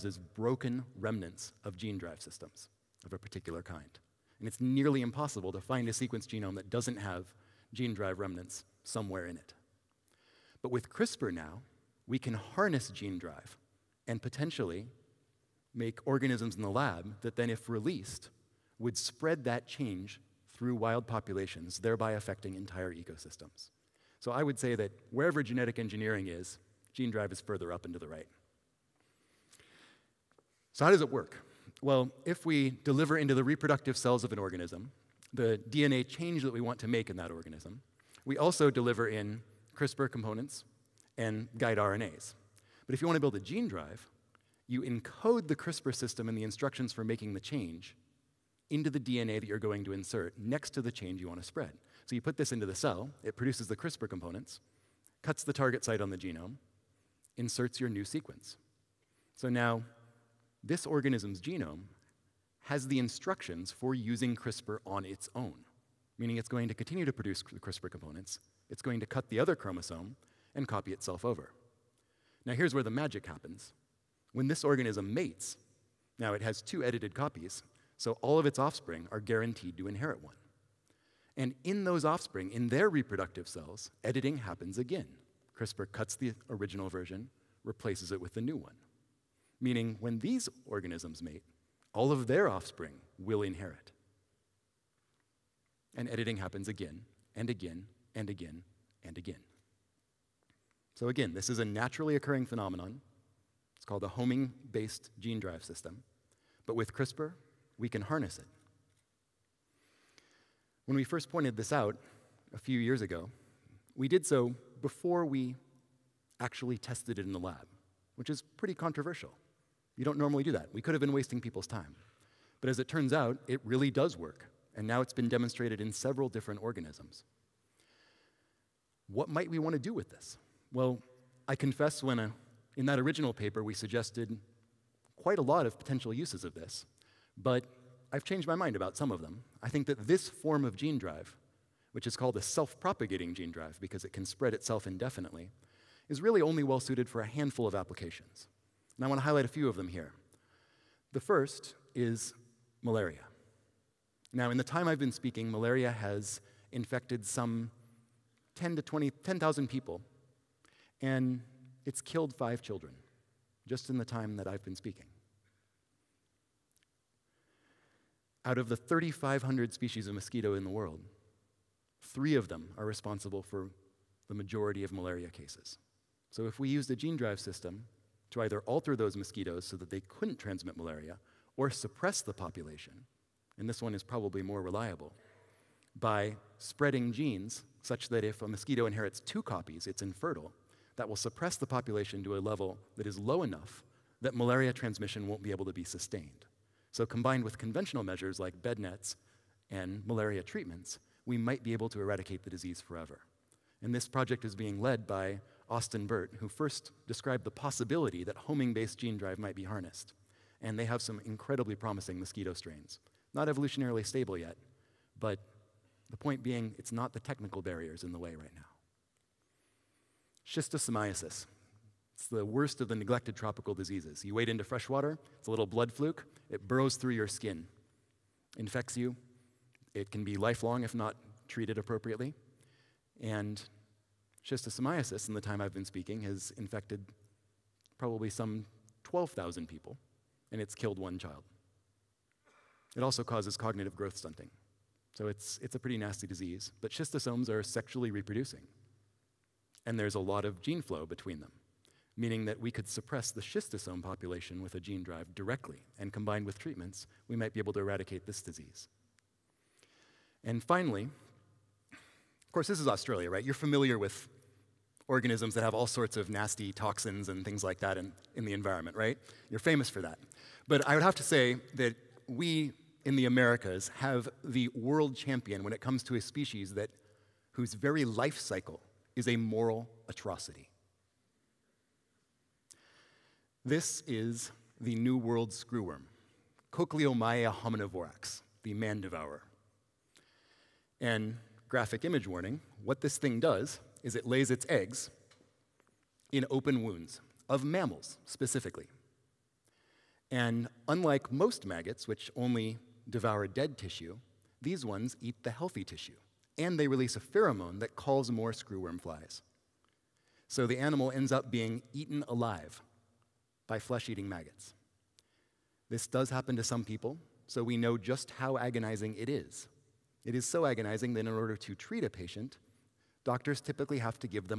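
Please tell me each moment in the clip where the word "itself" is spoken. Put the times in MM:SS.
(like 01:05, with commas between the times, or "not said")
01:10, 02:24.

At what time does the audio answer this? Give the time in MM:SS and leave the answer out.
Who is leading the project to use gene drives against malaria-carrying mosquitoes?
03:25.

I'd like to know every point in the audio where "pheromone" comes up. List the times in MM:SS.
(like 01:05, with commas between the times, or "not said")
05:07.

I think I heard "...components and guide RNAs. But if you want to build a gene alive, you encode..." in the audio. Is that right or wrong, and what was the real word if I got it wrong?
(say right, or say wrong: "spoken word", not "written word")
wrong: "drive", not "alive".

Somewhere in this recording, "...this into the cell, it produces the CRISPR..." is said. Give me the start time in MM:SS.
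00:52.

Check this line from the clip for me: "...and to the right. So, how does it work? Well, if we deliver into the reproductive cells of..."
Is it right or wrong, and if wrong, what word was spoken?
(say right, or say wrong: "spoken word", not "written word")
right.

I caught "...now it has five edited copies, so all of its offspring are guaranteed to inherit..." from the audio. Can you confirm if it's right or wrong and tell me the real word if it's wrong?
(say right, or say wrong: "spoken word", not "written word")
wrong: "two", not "five".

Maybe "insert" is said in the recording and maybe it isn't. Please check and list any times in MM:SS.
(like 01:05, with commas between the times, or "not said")
00:49, 00:57.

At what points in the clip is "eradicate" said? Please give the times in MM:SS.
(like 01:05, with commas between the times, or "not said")
03:21, 04:17.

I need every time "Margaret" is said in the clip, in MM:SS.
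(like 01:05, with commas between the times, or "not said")
not said.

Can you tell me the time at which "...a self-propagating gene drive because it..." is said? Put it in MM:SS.
02:22.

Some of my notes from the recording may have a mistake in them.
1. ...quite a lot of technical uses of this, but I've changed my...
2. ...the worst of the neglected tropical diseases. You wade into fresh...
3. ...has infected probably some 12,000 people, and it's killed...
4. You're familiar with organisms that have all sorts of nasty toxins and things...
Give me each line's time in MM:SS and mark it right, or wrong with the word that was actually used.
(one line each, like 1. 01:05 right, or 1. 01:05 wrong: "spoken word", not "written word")
1. 02:15 wrong: "potential", not "technical"
2. 03:42 right
3. 03:56 right
4. 04:23 right.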